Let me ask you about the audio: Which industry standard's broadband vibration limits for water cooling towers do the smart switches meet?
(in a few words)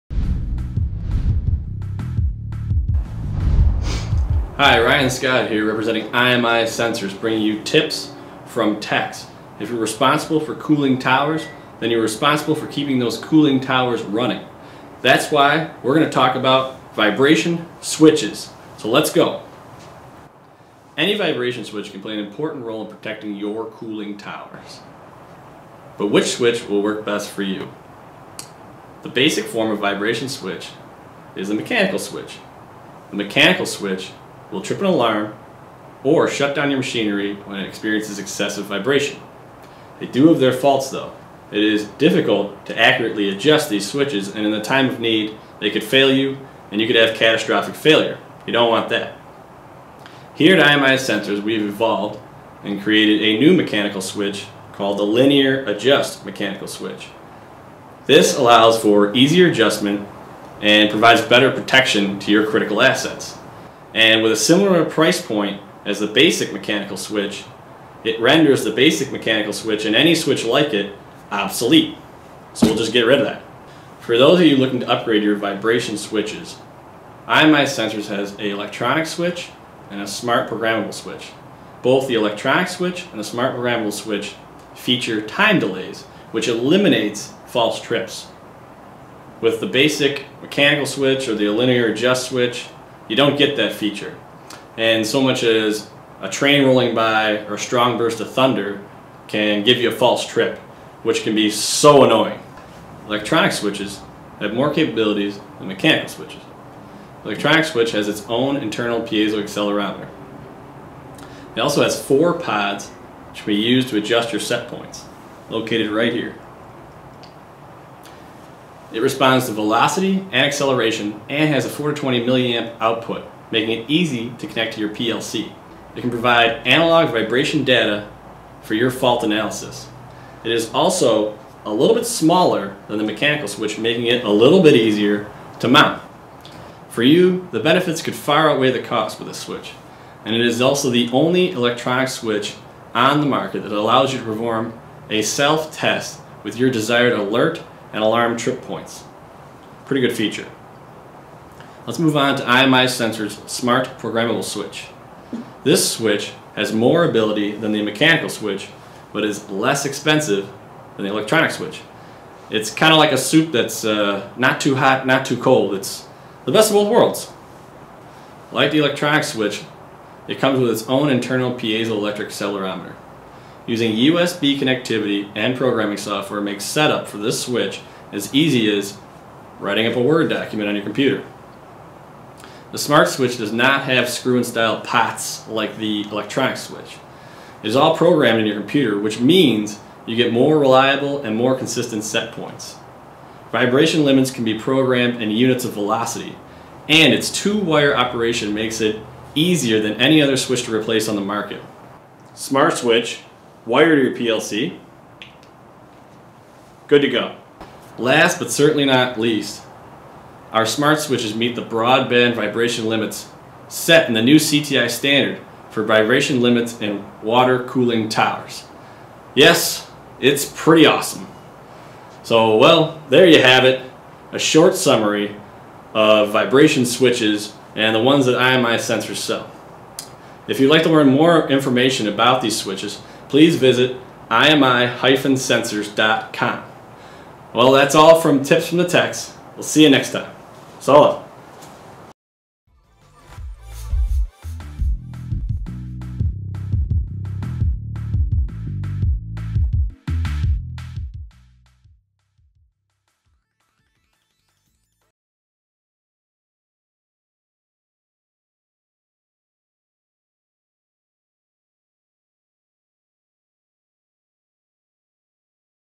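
CTI standard.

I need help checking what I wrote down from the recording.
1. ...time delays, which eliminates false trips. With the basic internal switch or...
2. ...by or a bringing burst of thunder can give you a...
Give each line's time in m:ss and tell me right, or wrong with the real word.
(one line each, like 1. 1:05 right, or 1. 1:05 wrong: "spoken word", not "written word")
1. 1:25 wrong: "mechanical", not "internal"
2. 1:36 wrong: "strong", not "bringing".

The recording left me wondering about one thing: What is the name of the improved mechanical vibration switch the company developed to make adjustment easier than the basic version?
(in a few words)
linear adjust mechanical switch.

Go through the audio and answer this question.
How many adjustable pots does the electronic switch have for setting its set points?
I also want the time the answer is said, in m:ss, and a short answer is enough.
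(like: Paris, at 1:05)
4, at 1:52.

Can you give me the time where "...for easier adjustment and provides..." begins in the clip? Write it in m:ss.
0:58.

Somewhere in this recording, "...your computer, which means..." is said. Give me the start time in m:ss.
3:08.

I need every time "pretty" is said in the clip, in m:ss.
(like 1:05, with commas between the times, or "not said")
2:29, 3:40.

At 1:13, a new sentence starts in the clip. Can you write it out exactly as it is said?
For those of you looking to upgrade your vibration switches, IMI Sensors has an electronic switch and a smart programmable switch.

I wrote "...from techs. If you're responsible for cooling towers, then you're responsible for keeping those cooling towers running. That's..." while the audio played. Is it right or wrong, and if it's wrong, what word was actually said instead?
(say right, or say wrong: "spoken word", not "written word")
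right.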